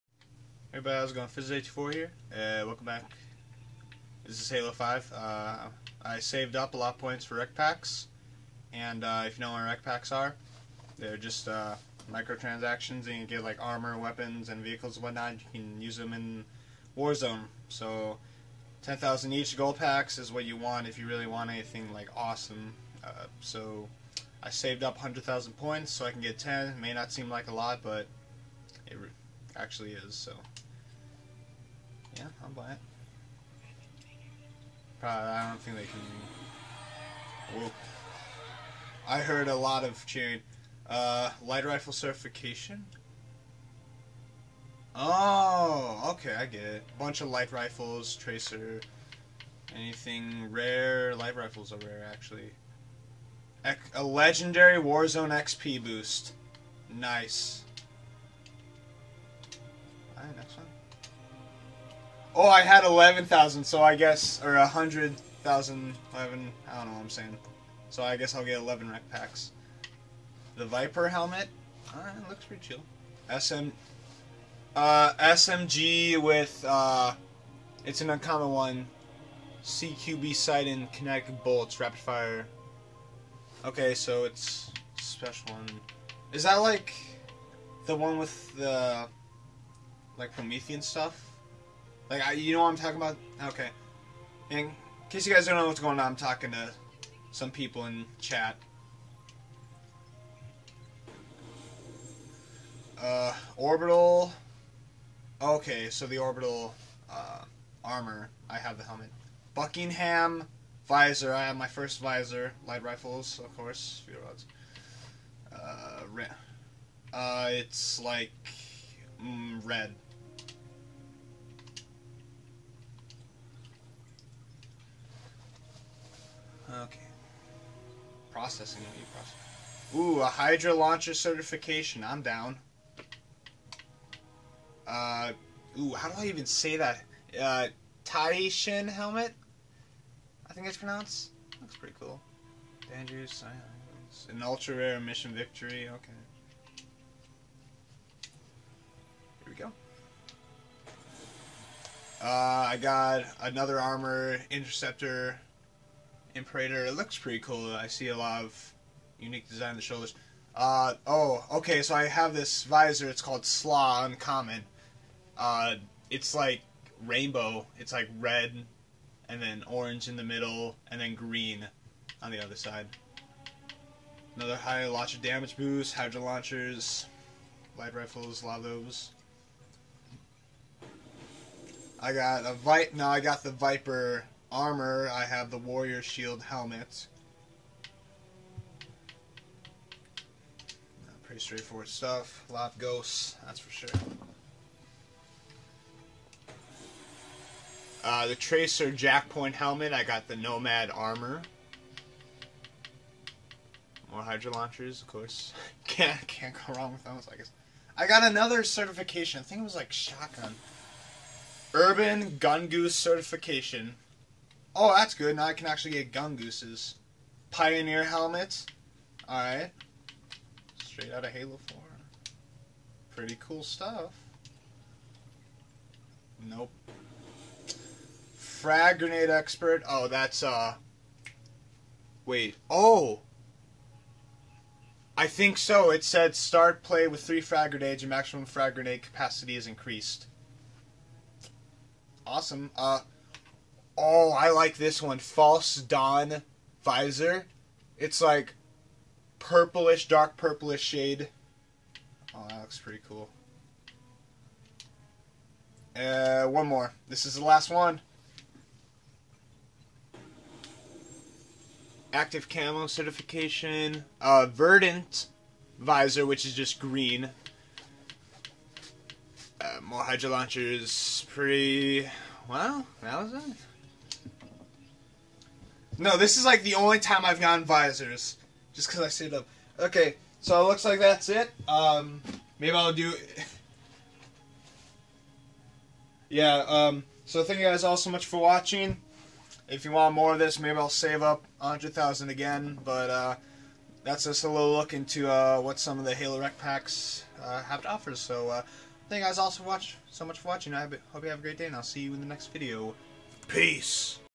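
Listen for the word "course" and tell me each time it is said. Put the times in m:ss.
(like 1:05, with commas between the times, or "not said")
1:53, 3:25.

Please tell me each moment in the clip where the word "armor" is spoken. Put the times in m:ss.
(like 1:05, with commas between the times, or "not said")
0:13, 1:47, 2:33, 3:04, 3:20.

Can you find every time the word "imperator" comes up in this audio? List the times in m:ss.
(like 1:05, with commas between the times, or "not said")
2:36.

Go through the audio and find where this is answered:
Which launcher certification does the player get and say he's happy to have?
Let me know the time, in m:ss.
2:10.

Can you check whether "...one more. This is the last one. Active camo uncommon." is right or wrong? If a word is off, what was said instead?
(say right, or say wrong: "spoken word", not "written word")
wrong: "certification", not "uncommon".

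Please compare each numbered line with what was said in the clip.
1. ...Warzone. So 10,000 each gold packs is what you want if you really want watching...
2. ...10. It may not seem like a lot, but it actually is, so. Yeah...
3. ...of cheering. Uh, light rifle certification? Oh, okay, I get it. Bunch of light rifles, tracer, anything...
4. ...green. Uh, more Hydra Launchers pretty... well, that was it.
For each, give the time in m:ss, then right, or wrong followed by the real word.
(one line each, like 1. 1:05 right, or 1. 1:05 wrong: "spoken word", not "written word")
1. 0:16 wrong: "anything", not "watching"
2. 0:26 right
3. 0:39 right
4. 4:26 right.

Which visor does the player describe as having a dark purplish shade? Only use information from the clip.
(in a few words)
False Dawn.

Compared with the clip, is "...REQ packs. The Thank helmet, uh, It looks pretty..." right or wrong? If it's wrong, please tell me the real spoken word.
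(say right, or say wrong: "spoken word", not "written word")
wrong: "Viper", not "Thank".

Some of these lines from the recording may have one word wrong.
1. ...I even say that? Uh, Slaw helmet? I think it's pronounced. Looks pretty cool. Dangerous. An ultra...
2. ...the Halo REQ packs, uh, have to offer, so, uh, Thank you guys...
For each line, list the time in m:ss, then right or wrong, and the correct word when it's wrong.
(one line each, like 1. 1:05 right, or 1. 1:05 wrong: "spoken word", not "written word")
1. 2:16 wrong: "Shin", not "Slaw"
2. 4:56 right.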